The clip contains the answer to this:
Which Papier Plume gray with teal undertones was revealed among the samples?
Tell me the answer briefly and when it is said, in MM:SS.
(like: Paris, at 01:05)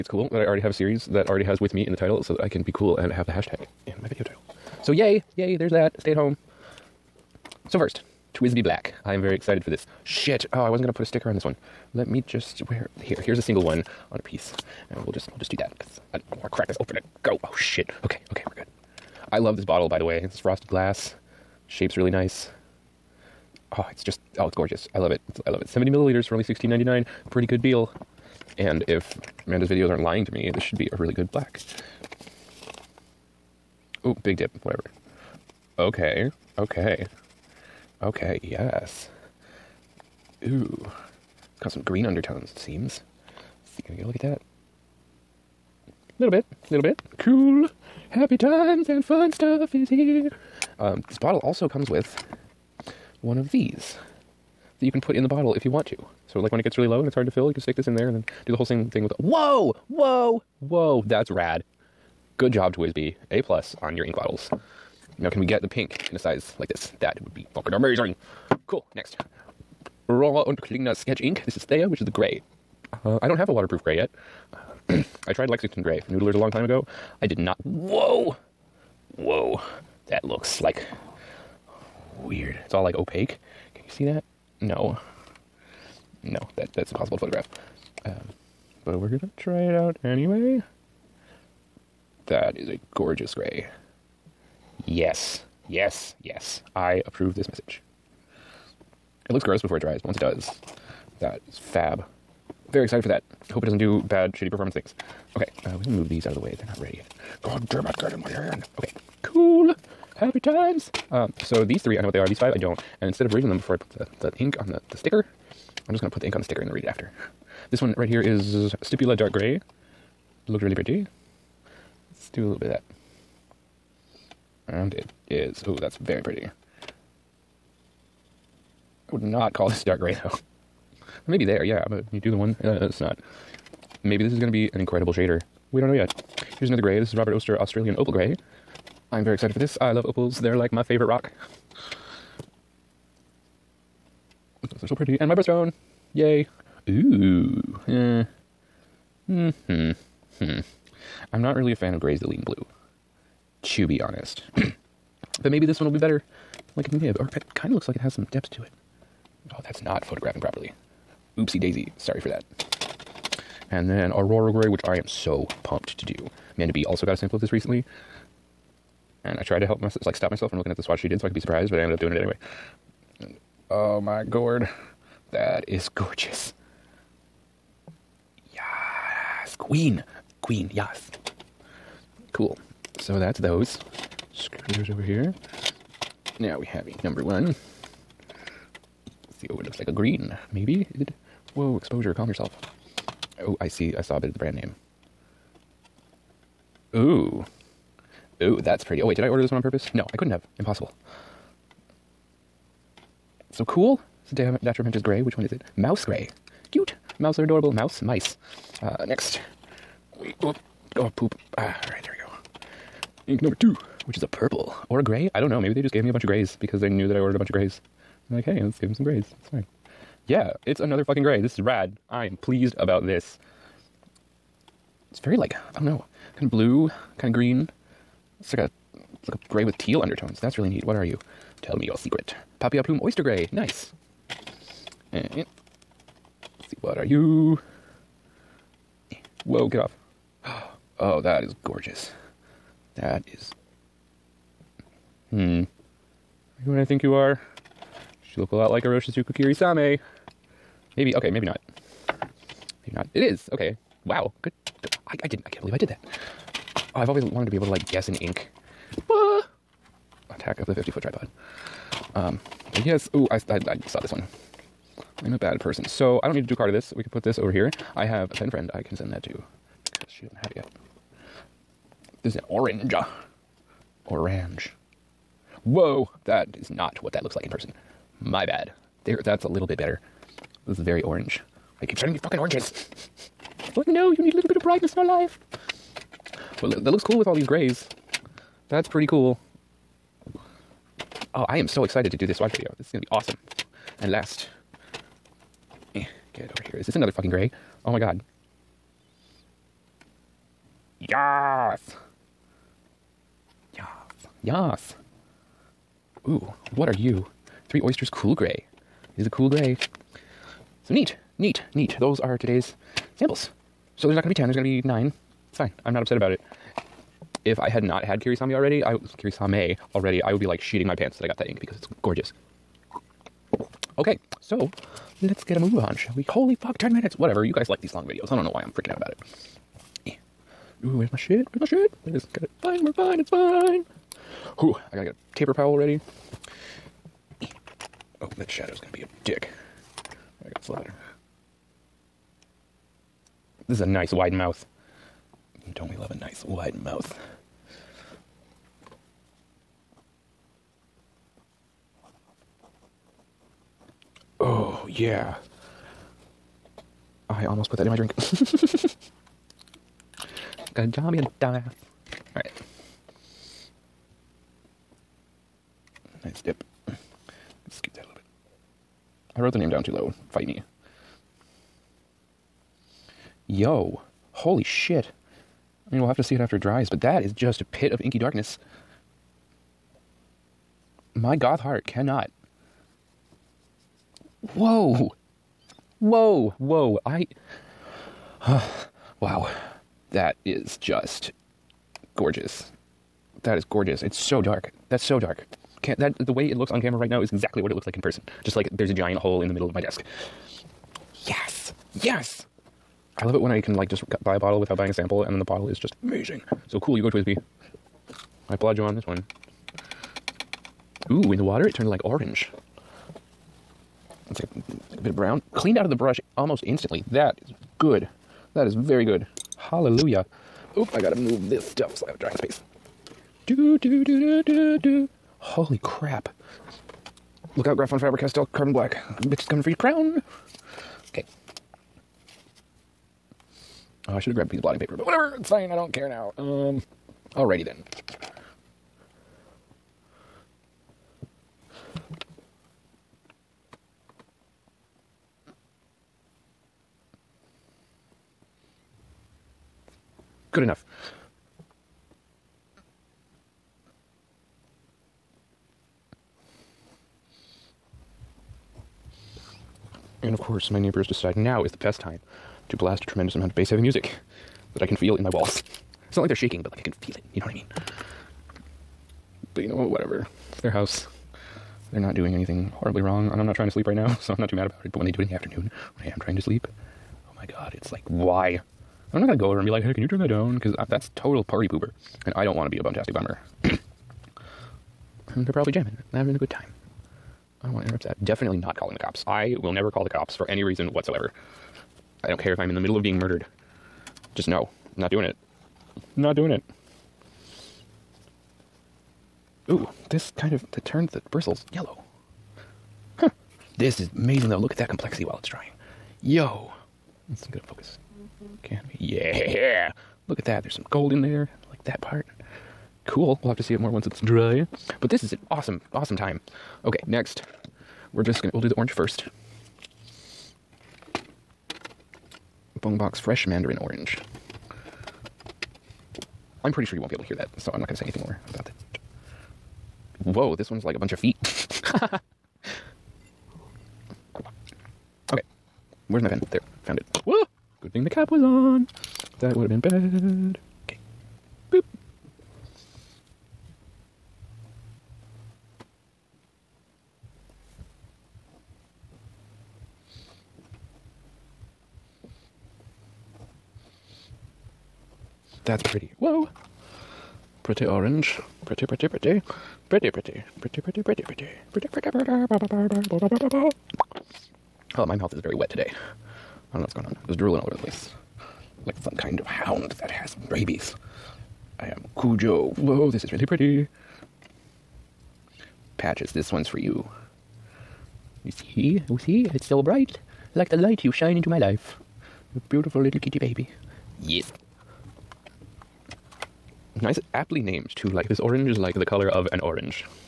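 Oyster gray, at 03:53.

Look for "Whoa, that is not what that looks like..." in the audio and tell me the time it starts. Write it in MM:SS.
04:35.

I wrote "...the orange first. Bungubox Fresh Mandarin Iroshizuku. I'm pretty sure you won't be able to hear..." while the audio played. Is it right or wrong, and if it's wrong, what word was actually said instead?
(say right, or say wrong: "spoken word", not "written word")
wrong: "Orange", not "Iroshizuku".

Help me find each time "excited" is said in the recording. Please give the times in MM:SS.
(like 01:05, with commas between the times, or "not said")
00:09, 01:42, 02:19, 04:51.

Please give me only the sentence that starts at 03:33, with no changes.
Ink number two, which is a purple or a gray.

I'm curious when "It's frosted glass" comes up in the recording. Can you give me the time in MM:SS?
00:20.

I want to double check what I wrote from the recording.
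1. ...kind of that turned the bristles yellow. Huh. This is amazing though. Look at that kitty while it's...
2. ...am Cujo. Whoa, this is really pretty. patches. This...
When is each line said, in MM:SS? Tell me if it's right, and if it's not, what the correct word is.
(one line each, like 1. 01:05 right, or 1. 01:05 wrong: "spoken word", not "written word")
1. 08:20 wrong: "complexity", not "kitty"
2. 09:31 right.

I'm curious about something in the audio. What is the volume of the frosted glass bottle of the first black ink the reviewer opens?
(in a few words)
70 milliliters.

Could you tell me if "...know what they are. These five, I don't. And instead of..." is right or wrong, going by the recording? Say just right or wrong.
right.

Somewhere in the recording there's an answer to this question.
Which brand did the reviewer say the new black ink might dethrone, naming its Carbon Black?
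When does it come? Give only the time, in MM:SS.
07:07.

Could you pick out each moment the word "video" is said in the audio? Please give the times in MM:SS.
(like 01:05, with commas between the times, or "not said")
00:04, 00:29, 04:52, 05:28.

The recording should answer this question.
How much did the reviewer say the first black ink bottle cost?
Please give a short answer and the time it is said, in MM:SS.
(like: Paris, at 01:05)
16.99, at 00:26.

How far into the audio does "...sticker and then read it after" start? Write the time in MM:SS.
01:56.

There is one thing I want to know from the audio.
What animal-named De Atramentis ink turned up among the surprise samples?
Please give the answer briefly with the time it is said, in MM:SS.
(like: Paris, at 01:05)
Mouse gray, at 03:25.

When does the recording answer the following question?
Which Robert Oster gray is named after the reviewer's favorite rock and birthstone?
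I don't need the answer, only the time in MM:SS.
02:17.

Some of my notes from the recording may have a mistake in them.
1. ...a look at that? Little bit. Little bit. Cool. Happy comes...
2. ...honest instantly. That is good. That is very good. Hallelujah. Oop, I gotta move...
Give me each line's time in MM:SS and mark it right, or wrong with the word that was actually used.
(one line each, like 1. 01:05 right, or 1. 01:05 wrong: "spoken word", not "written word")
1. 00:44 wrong: "times", not "comes"
2. 06:56 wrong: "almost", not "honest".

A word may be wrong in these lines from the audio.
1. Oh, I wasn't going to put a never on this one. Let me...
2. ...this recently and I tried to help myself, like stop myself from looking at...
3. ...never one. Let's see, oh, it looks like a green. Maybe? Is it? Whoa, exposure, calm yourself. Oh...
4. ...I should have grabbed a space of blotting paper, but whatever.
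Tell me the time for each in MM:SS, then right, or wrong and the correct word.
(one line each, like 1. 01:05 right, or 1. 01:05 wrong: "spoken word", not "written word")
1. 00:10 wrong: "sticker", not "never"
2. 02:47 right
3. 03:07 wrong: "number", not "never"
4. 07:14 wrong: "piece", not "space".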